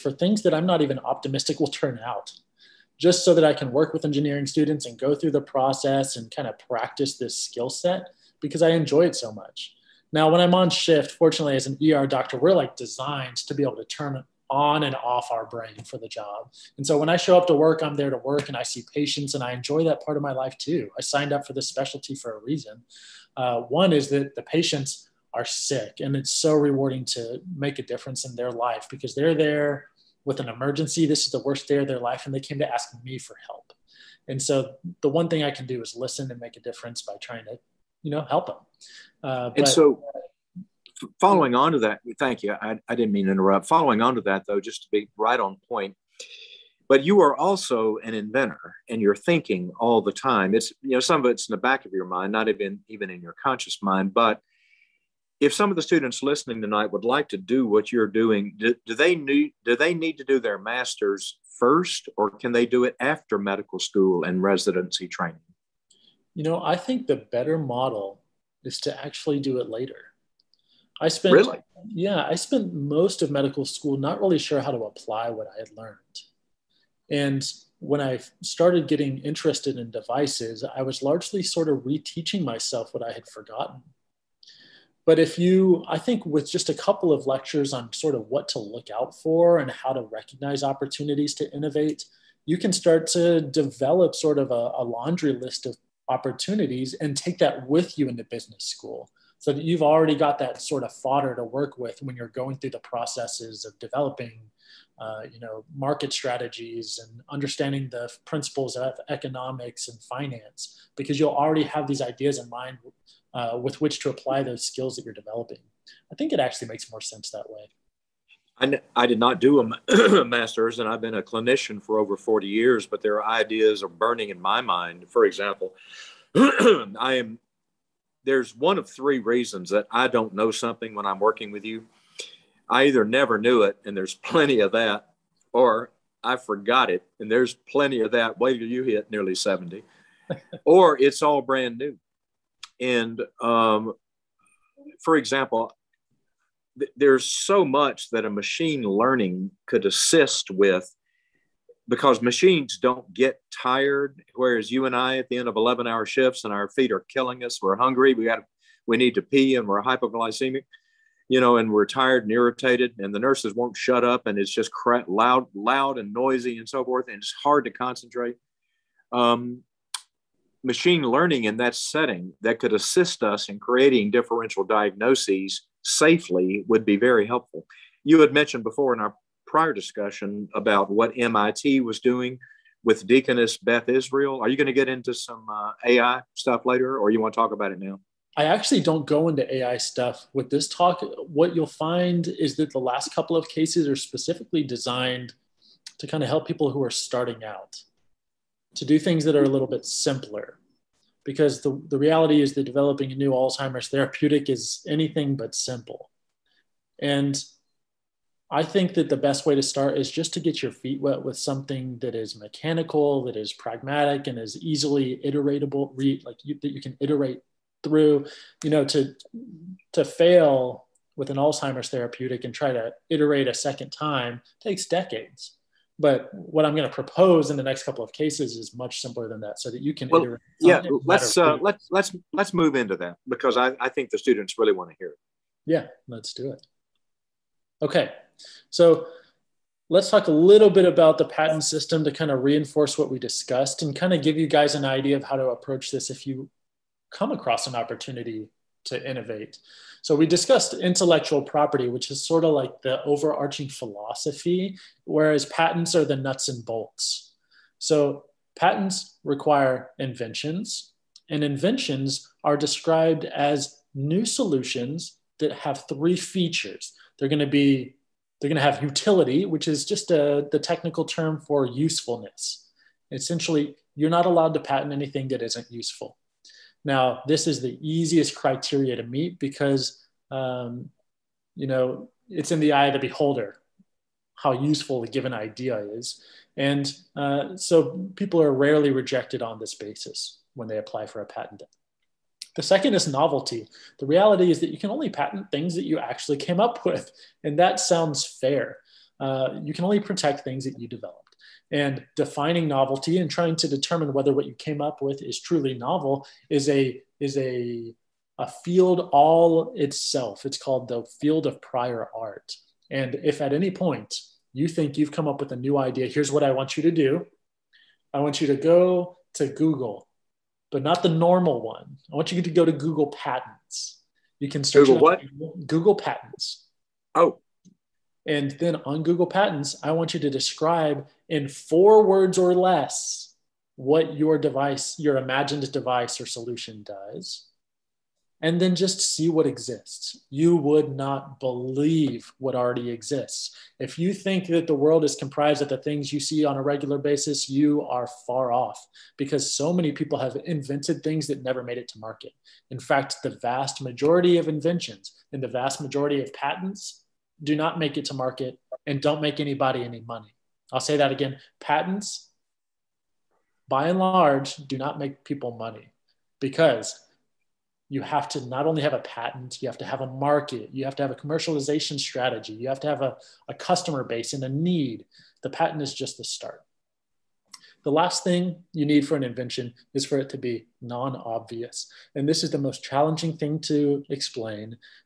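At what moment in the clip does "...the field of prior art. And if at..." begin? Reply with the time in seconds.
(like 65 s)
310 s.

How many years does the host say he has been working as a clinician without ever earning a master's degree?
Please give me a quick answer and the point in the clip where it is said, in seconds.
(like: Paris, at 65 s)
40, at 121 s.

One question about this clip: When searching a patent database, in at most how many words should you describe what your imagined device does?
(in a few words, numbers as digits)
4.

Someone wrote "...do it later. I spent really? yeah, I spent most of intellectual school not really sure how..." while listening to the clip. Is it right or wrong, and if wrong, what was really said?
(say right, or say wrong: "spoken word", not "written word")
wrong: "medical", not "intellectual".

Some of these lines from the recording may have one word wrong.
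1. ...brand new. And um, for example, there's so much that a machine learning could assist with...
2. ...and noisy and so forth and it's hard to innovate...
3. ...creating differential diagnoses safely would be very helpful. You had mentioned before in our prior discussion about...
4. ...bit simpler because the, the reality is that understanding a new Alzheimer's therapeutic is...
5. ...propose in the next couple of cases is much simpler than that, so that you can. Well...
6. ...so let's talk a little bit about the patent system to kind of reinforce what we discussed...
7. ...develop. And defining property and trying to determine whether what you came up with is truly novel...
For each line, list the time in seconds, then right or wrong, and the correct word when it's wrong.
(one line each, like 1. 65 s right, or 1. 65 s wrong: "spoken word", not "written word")
1. 141 s right
2. 165 s wrong: "concentrate", not "innovate"
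3. 173 s right
4. 199 s wrong: "developing", not "understanding"
5. 226 s right
6. 238 s right
7. 300 s wrong: "novelty", not "property".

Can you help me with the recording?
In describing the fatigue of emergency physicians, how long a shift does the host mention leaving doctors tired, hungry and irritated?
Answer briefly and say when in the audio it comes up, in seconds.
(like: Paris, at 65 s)
11 hours, at 155 s.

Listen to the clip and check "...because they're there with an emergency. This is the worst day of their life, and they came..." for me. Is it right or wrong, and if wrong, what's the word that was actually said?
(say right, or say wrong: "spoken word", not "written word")
right.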